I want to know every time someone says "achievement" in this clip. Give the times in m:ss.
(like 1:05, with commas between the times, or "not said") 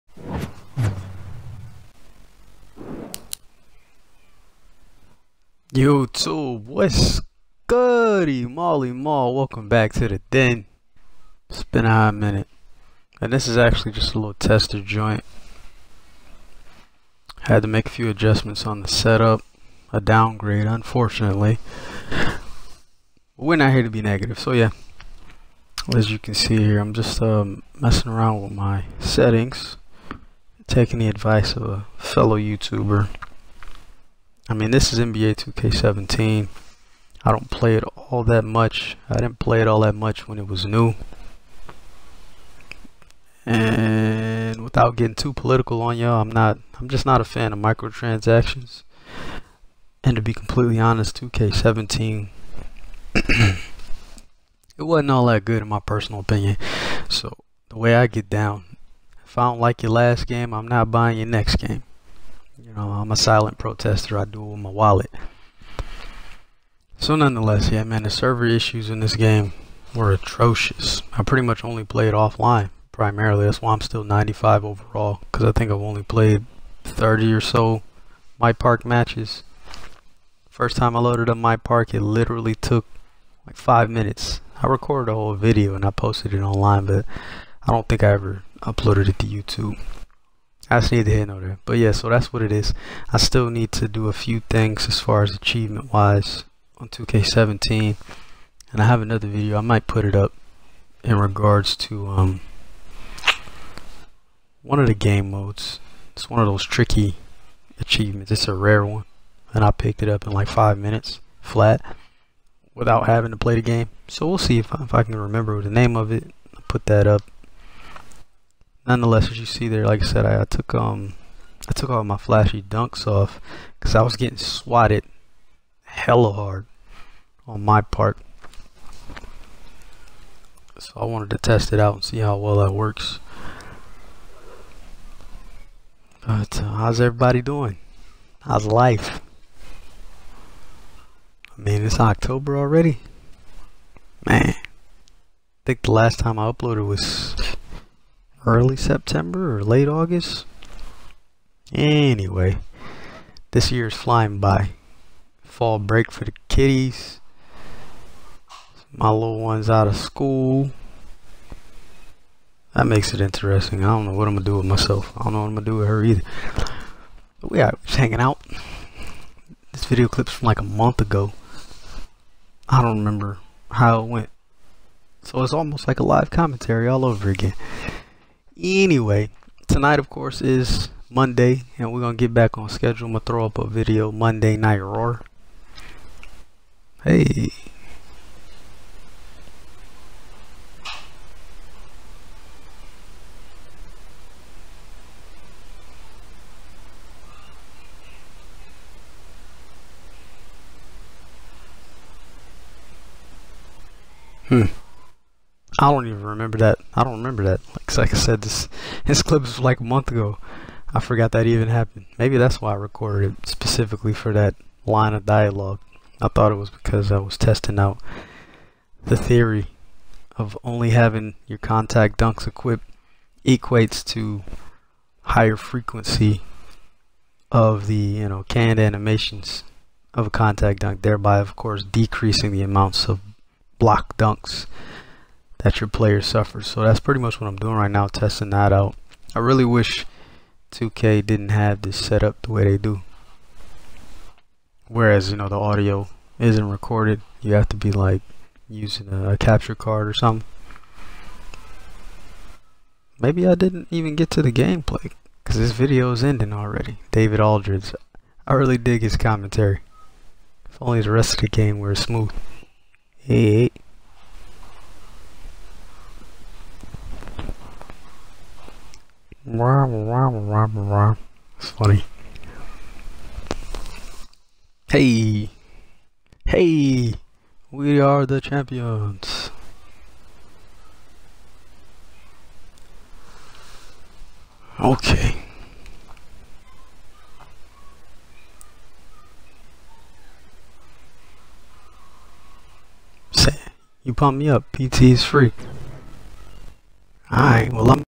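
1:35, 1:47.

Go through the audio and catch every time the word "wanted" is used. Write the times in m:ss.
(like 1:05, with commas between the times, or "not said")
2:11.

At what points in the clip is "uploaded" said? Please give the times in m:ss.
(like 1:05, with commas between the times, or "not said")
1:28, 2:26.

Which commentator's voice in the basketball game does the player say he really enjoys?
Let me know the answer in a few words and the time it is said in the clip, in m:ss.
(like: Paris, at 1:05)
David Aldridge, at 4:17.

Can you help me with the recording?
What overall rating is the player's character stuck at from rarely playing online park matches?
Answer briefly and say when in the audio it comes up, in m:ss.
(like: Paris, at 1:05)
95, at 1:14.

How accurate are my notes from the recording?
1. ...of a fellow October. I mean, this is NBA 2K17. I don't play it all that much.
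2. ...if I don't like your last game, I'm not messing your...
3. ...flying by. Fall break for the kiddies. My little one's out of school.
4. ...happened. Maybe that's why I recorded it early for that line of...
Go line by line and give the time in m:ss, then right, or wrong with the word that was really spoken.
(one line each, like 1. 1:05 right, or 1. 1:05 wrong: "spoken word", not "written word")
1. 0:31 wrong: "YouTuber", not "October"
2. 0:59 wrong: "buying", not "messing"
3. 2:33 right
4. 3:31 wrong: "specifically", not "early".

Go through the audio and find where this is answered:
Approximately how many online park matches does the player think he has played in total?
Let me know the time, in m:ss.
1:16.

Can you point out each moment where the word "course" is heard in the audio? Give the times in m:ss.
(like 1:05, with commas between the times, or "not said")
3:00, 3:51.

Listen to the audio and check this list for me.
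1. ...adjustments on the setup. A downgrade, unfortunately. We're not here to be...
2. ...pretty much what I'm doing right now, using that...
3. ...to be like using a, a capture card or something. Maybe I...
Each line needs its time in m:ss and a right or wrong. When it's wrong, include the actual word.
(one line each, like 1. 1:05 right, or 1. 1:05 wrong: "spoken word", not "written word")
1. 0:18 right
2. 3:56 wrong: "testing", not "using"
3. 4:07 right.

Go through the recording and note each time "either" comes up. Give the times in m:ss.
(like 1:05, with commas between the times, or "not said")
2:46.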